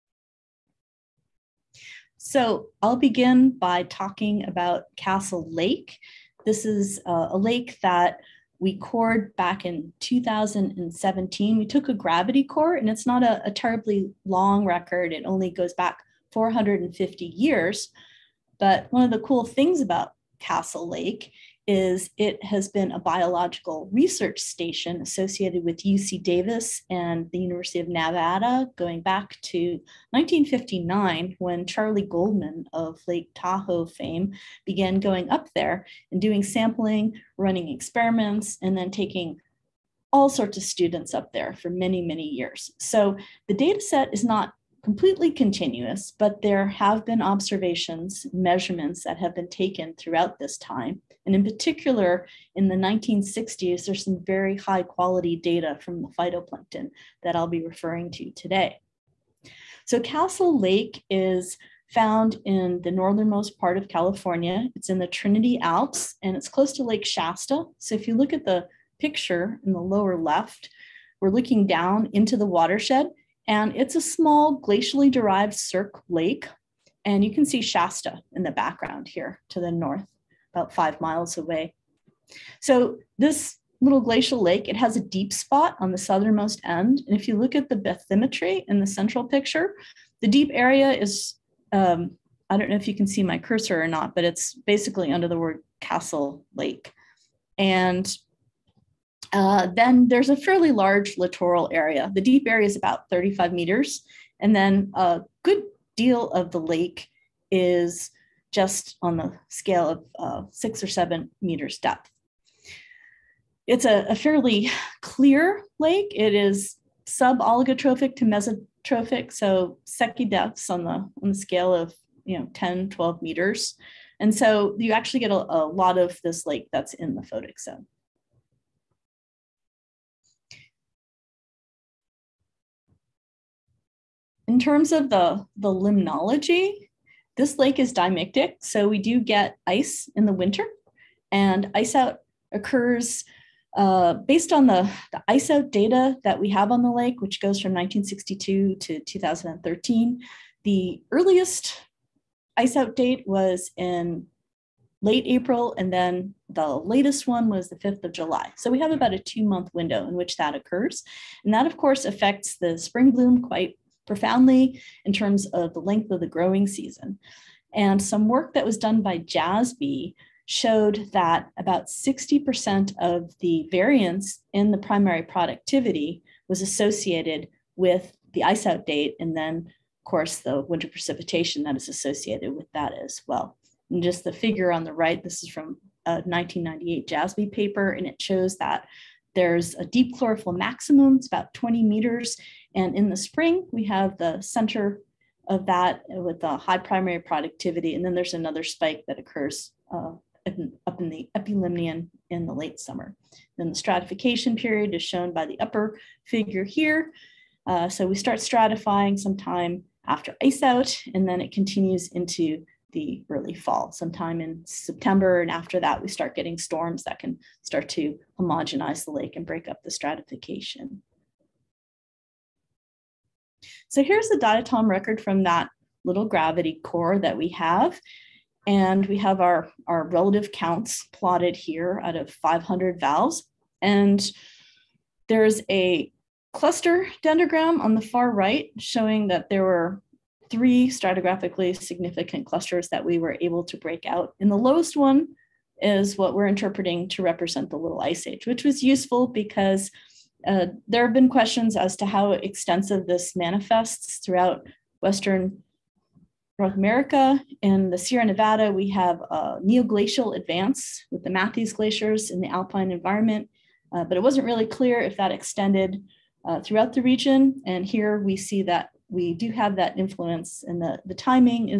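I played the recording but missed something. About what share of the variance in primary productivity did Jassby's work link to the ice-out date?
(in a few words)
60%.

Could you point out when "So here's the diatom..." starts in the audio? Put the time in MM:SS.
03:43.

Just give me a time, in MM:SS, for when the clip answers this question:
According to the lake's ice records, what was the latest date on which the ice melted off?
02:37.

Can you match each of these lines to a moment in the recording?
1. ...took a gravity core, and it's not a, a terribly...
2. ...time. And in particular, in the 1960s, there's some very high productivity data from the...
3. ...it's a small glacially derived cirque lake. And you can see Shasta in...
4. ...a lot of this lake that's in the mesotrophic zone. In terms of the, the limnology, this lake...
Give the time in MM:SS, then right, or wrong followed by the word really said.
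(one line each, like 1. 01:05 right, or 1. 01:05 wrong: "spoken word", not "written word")
1. 00:11 right
2. 00:50 wrong: "quality", not "productivity"
3. 01:13 right
4. 02:05 wrong: "photic", not "mesotrophic".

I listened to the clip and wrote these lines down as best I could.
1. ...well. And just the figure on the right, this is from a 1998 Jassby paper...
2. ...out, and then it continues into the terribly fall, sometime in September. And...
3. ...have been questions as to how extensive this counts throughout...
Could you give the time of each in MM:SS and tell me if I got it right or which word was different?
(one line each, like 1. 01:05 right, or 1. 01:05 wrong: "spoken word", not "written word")
1. 03:03 right
2. 03:30 wrong: "early", not "terribly"
3. 04:11 wrong: "manifests", not "counts".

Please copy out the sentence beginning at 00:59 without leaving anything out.
So Castle Lake is found in the northernmost part of California.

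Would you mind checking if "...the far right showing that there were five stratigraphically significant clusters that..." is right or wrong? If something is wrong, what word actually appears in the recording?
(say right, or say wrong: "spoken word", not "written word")
wrong: "three", not "five".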